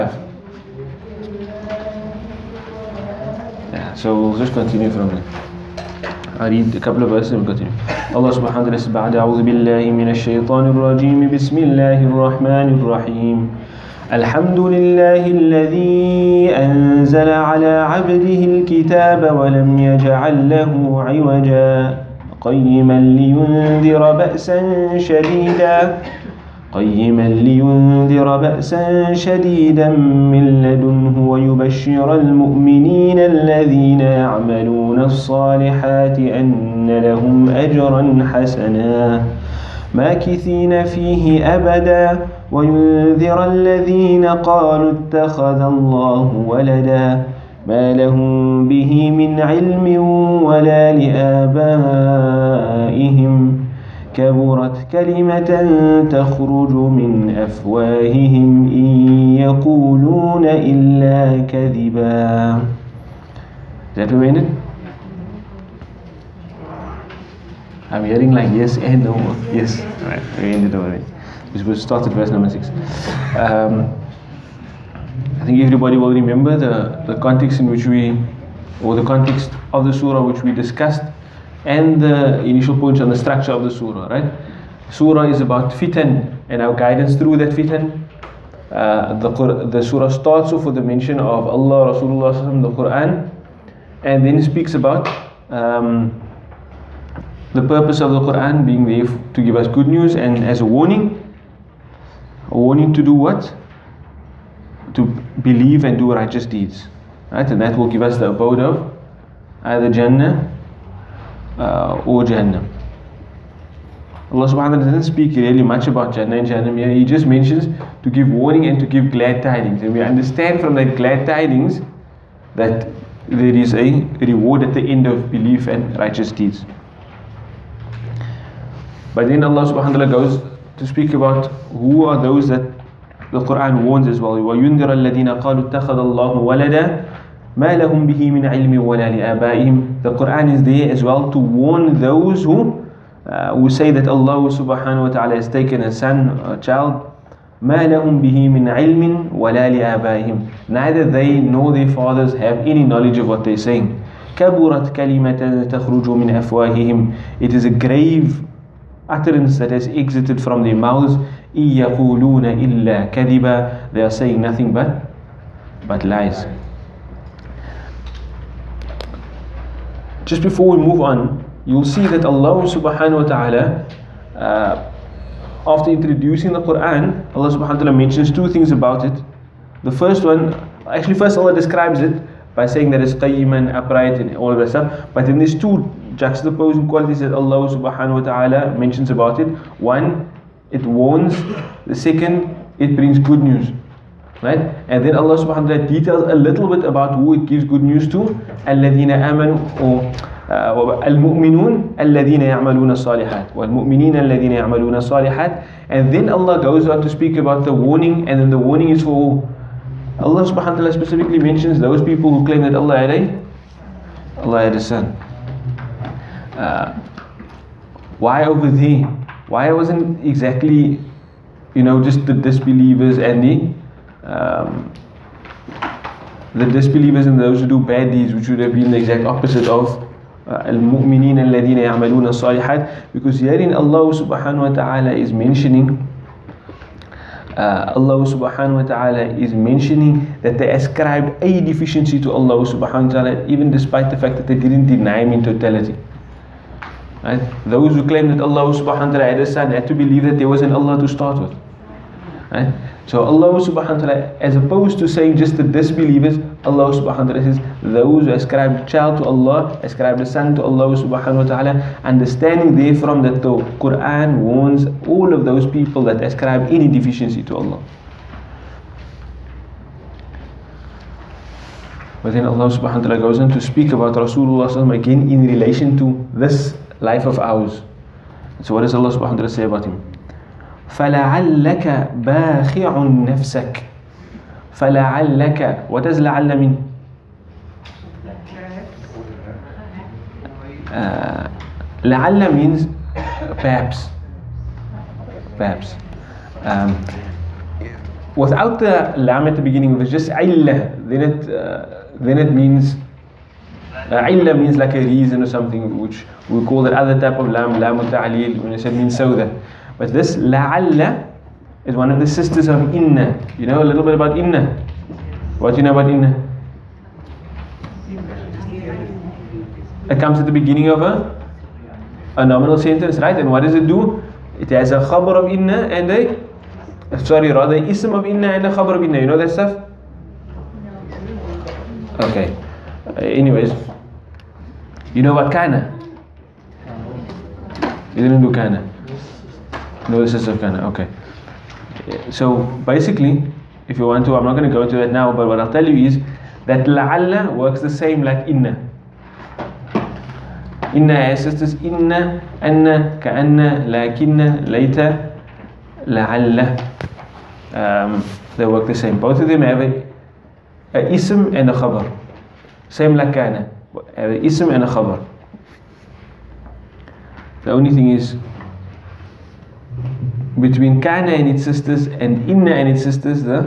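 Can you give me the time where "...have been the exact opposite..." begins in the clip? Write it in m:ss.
3:48.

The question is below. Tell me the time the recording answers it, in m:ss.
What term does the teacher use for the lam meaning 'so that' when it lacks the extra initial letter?
5:07.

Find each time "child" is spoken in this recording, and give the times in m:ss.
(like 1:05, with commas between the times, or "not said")
2:26, 4:18.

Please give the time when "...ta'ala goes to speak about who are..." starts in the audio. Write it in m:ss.
2:09.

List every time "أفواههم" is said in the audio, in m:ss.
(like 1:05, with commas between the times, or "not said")
0:57, 2:36.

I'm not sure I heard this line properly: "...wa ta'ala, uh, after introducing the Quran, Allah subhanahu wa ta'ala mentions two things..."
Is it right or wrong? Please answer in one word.
right.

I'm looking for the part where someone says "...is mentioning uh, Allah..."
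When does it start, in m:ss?
3:55.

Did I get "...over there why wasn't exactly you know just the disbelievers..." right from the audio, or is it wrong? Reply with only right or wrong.
right.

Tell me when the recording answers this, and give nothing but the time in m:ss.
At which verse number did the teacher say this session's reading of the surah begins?
1:12.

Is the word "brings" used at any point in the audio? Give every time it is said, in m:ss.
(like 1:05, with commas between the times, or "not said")
3:12.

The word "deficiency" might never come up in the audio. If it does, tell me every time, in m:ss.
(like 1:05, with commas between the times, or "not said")
4:01, 4:26.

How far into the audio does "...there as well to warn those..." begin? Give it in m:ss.
2:20.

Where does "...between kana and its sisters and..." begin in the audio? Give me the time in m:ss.
6:10.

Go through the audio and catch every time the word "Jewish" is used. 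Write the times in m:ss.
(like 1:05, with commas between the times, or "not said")
not said.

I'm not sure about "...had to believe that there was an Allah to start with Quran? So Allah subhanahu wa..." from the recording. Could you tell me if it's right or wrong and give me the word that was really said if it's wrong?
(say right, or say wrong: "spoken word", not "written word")
wrong: "Right", not "Quran".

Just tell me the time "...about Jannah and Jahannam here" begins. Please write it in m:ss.
1:55.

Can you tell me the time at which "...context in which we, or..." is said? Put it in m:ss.
1:17.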